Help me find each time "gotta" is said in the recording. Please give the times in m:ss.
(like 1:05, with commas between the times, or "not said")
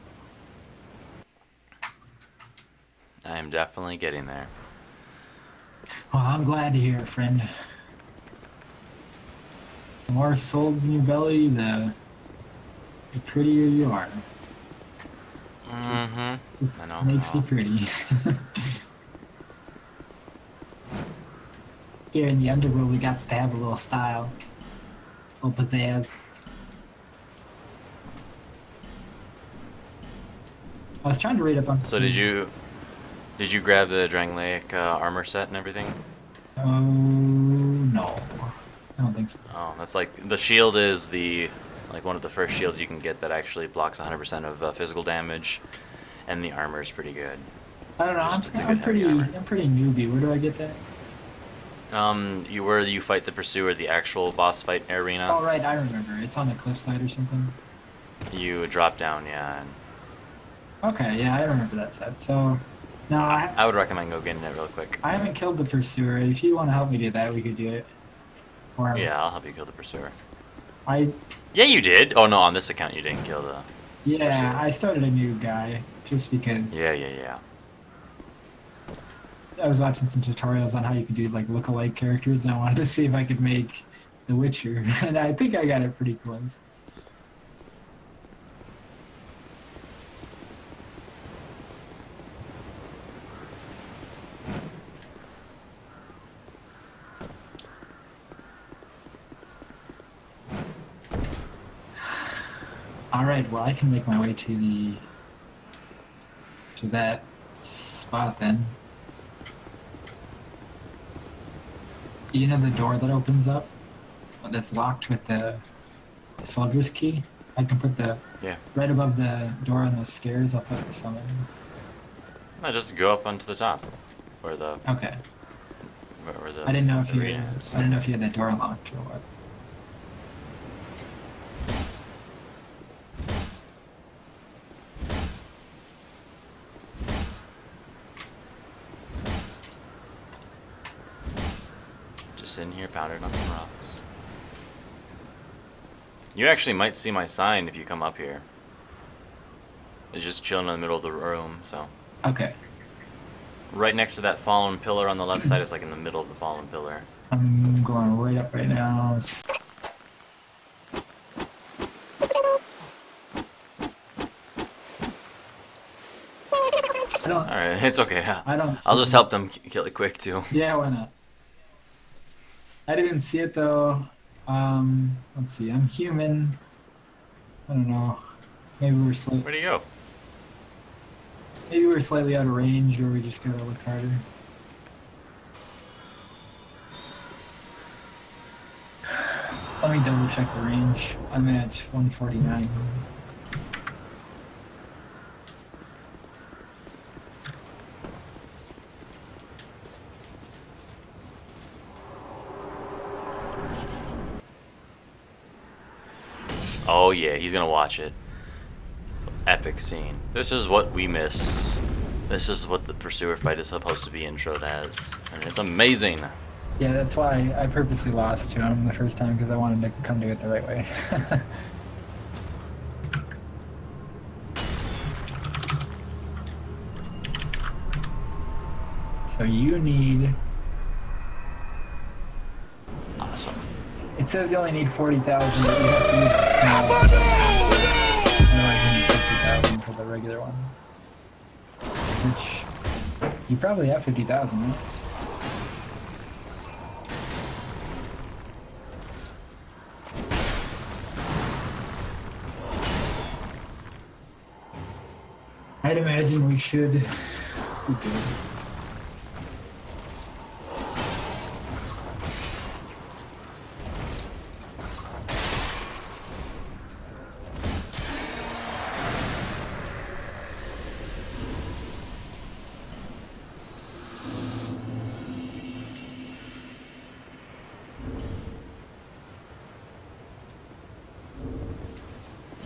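3:03.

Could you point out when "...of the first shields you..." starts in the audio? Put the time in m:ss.
0:42.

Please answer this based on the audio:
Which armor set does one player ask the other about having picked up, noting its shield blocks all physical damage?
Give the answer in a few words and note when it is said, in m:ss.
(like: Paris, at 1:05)
Drangleic, at 0:34.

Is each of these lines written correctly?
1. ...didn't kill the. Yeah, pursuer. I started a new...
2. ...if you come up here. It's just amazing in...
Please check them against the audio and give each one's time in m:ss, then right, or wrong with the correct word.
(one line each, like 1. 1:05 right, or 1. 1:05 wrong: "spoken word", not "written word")
1. 1:13 right
2. 2:27 wrong: "chilling", not "amazing".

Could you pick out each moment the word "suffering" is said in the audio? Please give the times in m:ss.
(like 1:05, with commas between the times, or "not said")
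not said.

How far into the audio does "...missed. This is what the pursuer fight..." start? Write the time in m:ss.
3:31.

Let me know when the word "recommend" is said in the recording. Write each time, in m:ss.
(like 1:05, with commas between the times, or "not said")
1:03.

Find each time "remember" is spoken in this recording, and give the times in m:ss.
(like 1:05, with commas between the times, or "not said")
0:55, 1:01.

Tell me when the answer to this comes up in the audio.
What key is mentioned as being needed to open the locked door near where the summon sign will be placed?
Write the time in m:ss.
1:56.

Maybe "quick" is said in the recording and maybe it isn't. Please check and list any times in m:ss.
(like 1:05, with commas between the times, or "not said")
1:04, 2:49.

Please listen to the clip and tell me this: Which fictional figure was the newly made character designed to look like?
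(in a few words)
The Witcher.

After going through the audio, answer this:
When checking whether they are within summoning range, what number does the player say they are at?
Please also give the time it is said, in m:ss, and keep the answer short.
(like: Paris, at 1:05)
149, at 3:11.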